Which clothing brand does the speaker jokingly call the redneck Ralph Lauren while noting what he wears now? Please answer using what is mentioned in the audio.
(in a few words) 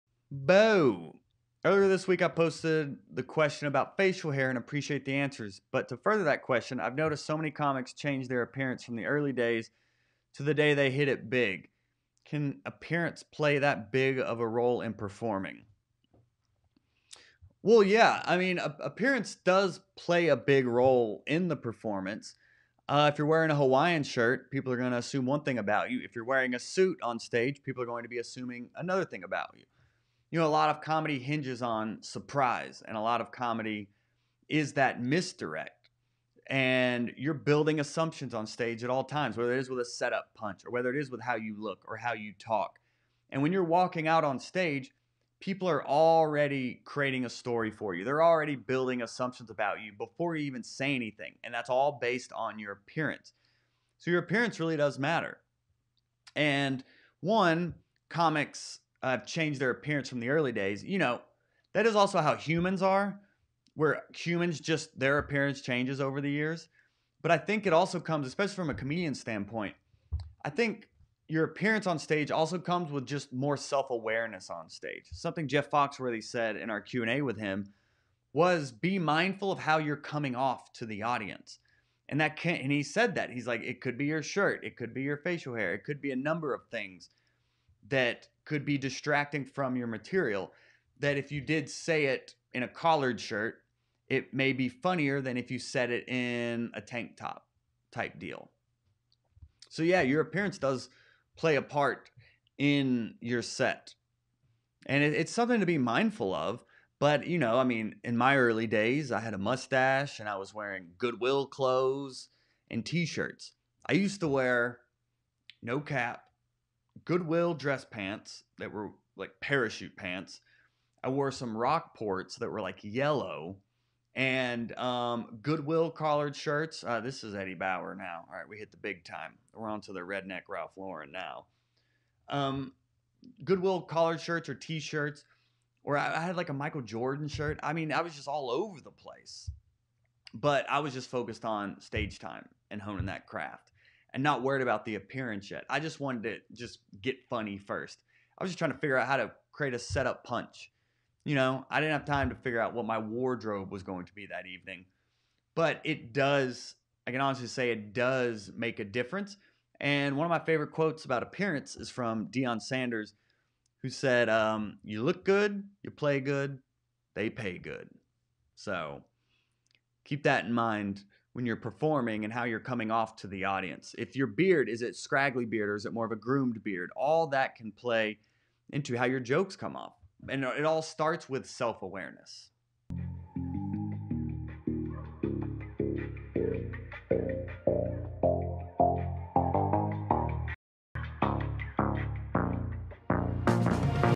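Eddie Bauer.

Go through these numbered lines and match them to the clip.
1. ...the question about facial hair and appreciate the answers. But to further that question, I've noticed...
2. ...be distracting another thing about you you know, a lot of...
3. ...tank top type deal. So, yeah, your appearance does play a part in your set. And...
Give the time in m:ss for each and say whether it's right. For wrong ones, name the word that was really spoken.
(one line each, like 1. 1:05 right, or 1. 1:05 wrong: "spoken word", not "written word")
1. 0:03 right
2. 0:28 wrong: "assuming", not "distracting"
3. 1:36 right.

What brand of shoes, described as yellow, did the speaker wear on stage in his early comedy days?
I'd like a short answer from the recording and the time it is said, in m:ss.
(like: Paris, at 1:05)
Rockports, at 2:01.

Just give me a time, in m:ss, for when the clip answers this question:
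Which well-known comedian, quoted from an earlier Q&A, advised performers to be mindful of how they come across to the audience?
1:15.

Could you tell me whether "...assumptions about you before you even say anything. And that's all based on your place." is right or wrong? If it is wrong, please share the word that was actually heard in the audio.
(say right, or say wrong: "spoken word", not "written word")
wrong: "appearance", not "place".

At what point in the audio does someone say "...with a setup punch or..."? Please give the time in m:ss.
0:39.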